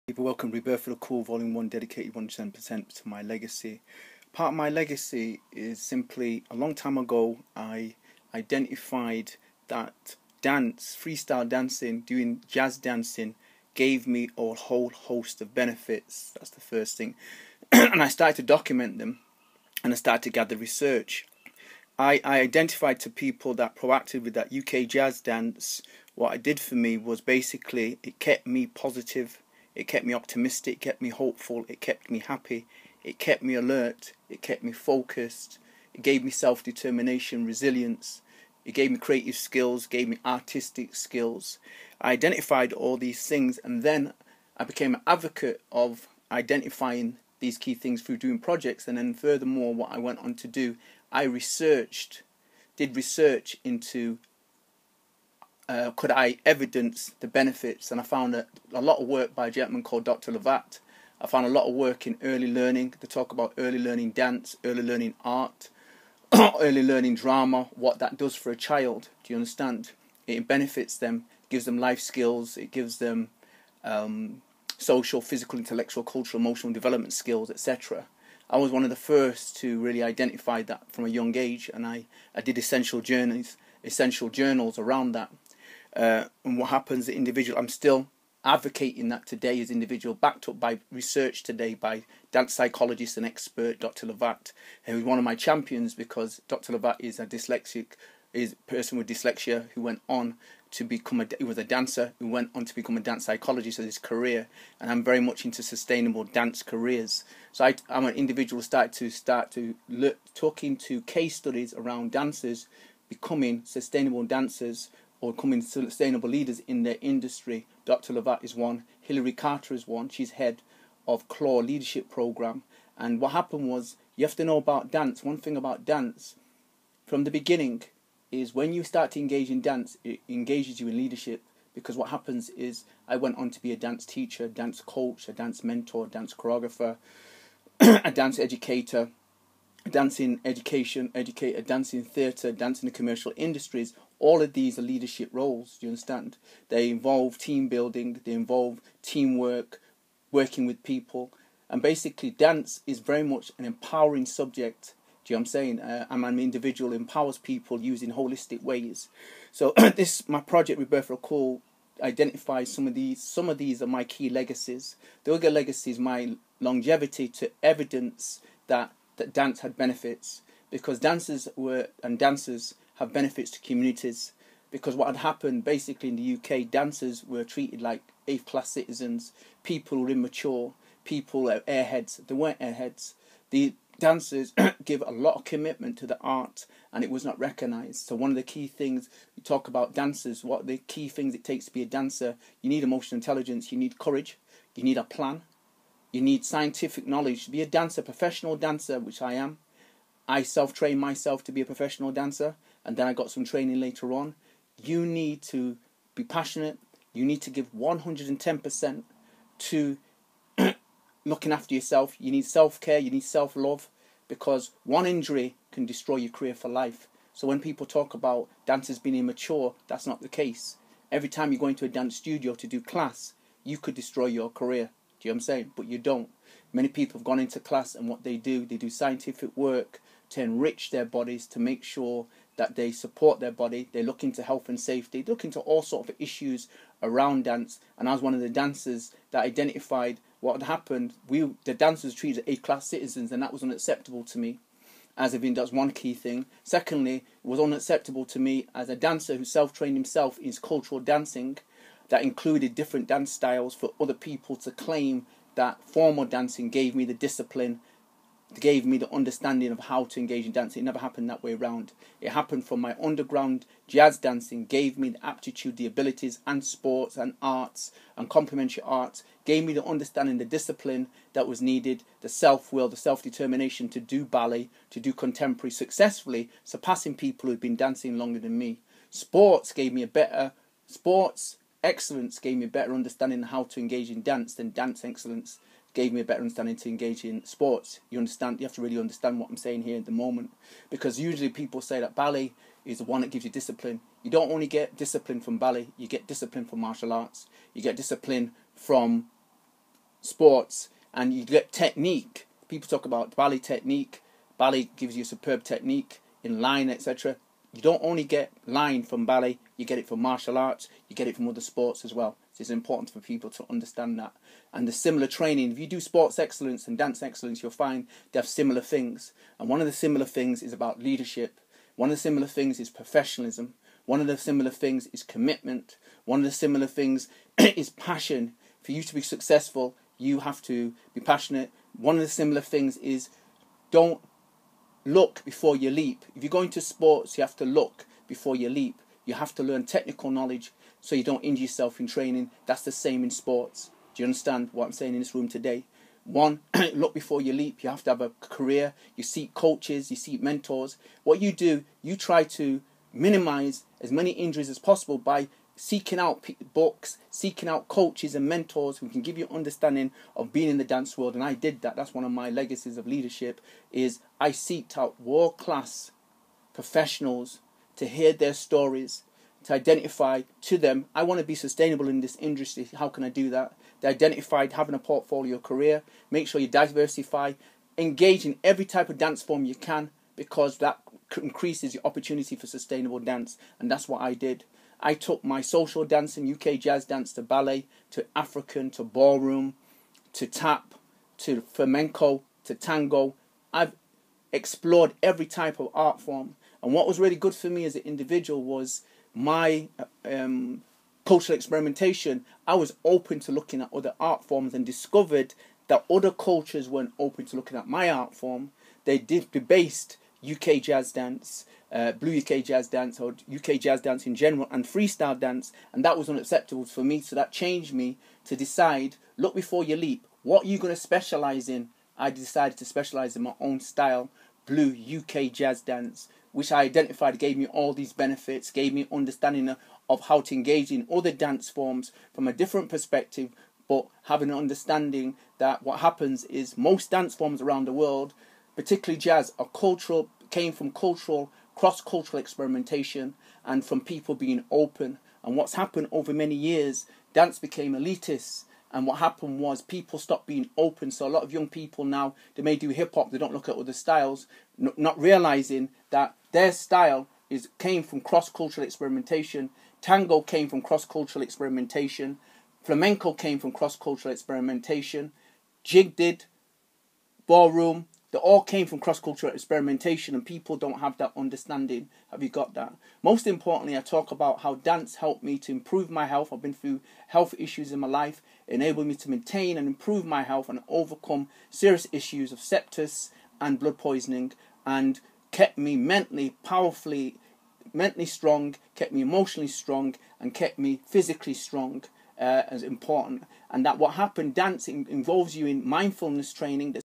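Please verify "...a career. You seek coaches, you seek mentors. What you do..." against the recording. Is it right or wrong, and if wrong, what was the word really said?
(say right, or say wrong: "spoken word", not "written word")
right.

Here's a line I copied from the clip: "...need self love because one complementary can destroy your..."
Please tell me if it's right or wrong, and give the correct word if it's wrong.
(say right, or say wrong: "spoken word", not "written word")
wrong: "injury", not "complementary".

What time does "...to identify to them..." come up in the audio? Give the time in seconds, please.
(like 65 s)
369 s.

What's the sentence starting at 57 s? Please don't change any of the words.
And I found a, a lot of work by a gentleman called Dr.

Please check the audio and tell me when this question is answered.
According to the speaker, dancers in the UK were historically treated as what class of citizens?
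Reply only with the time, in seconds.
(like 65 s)
178 s.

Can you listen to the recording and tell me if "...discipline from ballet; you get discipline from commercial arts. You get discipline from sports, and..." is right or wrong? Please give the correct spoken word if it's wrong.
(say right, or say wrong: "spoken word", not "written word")
wrong: "martial", not "commercial".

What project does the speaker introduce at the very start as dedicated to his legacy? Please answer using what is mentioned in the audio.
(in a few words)
Rebirth of the Call Volume 1.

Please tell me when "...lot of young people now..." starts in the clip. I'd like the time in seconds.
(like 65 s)
451 s.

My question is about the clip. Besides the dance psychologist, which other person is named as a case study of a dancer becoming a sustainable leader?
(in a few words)
Hillary Carter.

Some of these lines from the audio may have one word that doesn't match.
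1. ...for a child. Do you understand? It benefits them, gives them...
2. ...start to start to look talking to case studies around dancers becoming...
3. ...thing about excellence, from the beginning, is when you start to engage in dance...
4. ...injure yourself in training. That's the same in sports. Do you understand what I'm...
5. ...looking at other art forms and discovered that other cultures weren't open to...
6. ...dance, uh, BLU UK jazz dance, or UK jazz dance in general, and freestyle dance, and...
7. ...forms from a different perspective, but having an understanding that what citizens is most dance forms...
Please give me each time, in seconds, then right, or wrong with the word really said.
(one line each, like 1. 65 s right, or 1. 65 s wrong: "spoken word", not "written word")
1. 68 s right
2. 108 s right
3. 125 s wrong: "dance", not "excellence"
4. 341 s right
5. 403 s right
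6. 411 s right
7. 431 s wrong: "happens", not "citizens".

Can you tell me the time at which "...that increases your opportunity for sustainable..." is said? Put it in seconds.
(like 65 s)
380 s.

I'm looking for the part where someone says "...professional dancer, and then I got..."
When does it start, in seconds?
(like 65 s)
201 s.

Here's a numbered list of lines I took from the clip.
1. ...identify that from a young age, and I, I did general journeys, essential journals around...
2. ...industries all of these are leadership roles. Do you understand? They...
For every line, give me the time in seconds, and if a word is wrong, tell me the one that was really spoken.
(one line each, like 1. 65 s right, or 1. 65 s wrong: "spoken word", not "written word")
1. 80 s wrong: "essential", not "general"
2. 143 s right.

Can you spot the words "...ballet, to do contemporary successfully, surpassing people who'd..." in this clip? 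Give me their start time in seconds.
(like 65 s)
274 s.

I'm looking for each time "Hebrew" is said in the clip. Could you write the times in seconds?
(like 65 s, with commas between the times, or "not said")
not said.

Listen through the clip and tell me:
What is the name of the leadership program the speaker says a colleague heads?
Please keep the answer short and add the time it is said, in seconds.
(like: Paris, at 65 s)
Claw Leadership Program, at 121 s.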